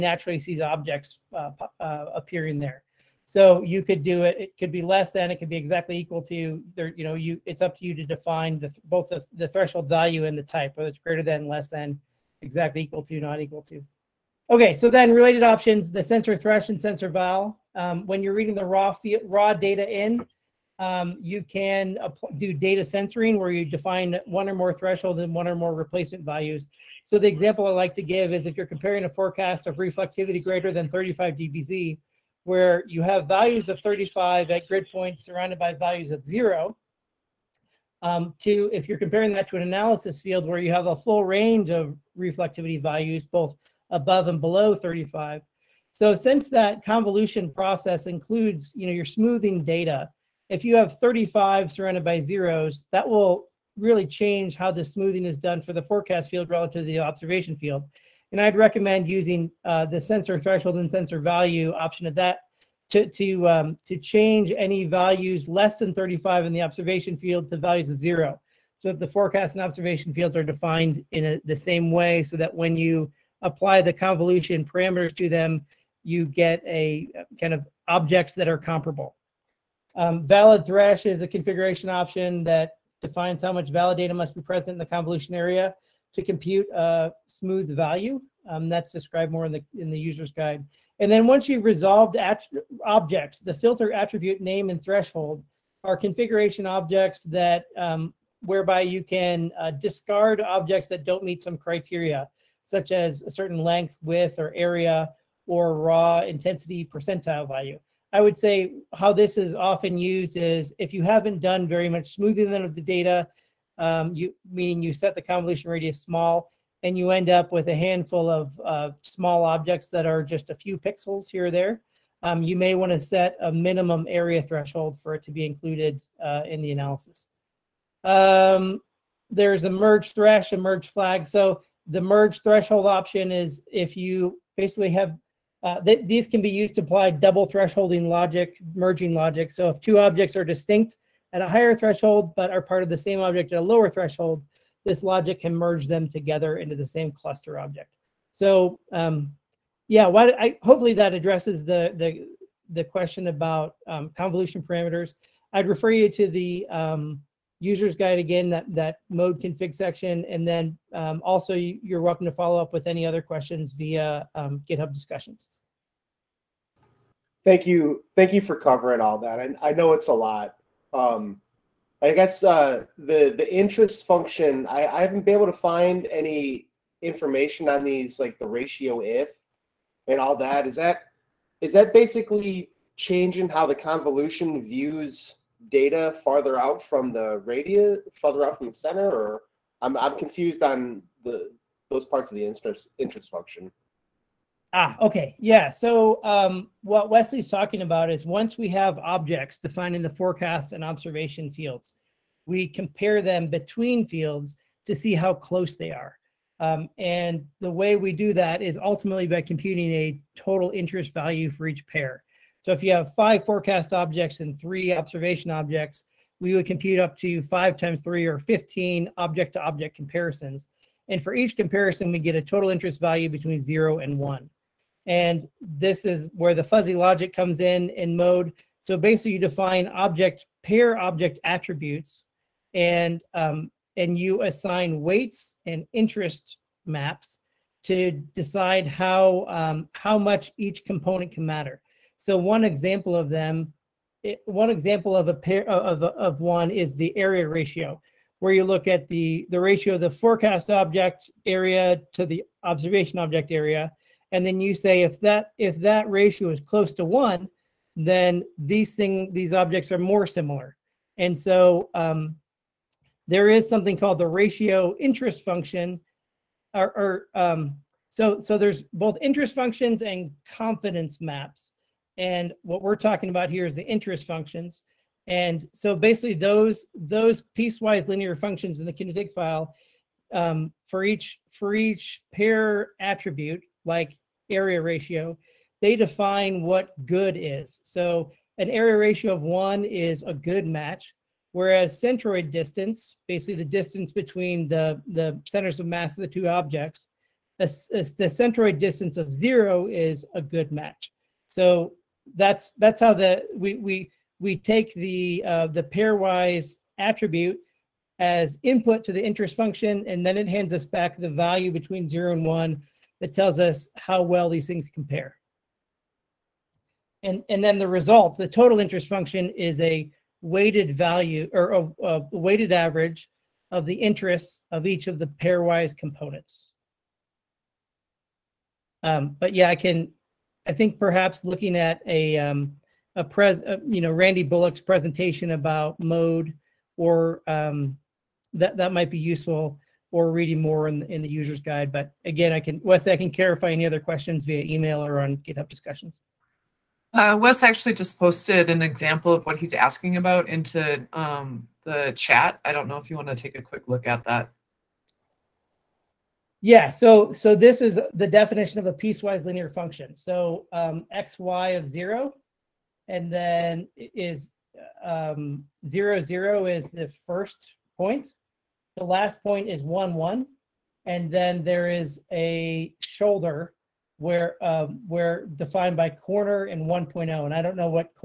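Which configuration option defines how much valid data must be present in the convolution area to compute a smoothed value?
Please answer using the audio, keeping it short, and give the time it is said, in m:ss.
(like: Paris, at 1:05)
valid thresh, at 1:20.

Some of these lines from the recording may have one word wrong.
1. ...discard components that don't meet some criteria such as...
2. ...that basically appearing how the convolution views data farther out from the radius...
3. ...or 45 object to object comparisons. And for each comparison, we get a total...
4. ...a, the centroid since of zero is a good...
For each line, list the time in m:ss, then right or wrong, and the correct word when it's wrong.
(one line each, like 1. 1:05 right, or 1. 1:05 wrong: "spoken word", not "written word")
1. 1:39 wrong: "objects", not "components"
2. 3:01 wrong: "changing", not "appearing"
3. 3:38 wrong: "15", not "45"
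4. 4:57 wrong: "distance", not "since".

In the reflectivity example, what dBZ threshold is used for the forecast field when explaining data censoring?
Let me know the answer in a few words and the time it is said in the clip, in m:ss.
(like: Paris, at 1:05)
35, at 0:30.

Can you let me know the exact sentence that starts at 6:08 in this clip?
The last point is one, one, and then there is a shoulder where um, where defined by corner and 1.0.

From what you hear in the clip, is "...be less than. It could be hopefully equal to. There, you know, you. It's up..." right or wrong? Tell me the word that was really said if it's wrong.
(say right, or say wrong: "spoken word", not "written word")
wrong: "exactly", not "hopefully".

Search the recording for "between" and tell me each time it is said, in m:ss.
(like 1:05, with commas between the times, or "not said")
3:23, 3:43, 4:54, 5:11.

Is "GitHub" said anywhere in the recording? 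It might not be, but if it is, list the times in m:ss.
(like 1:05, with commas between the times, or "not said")
2:44, 5:45.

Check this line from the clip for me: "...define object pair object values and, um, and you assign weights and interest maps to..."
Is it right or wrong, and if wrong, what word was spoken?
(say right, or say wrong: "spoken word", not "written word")
wrong: "attributes", not "values".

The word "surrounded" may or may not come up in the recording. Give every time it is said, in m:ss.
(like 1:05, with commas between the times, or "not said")
0:35, 0:51.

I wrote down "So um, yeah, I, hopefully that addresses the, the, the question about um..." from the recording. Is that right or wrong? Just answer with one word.
right.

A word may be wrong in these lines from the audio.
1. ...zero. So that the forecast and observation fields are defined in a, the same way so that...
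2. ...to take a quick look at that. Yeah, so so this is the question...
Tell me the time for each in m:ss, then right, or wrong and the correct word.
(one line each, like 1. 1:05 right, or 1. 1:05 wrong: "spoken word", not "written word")
1. 1:07 right
2. 5:53 wrong: "definition", not "question".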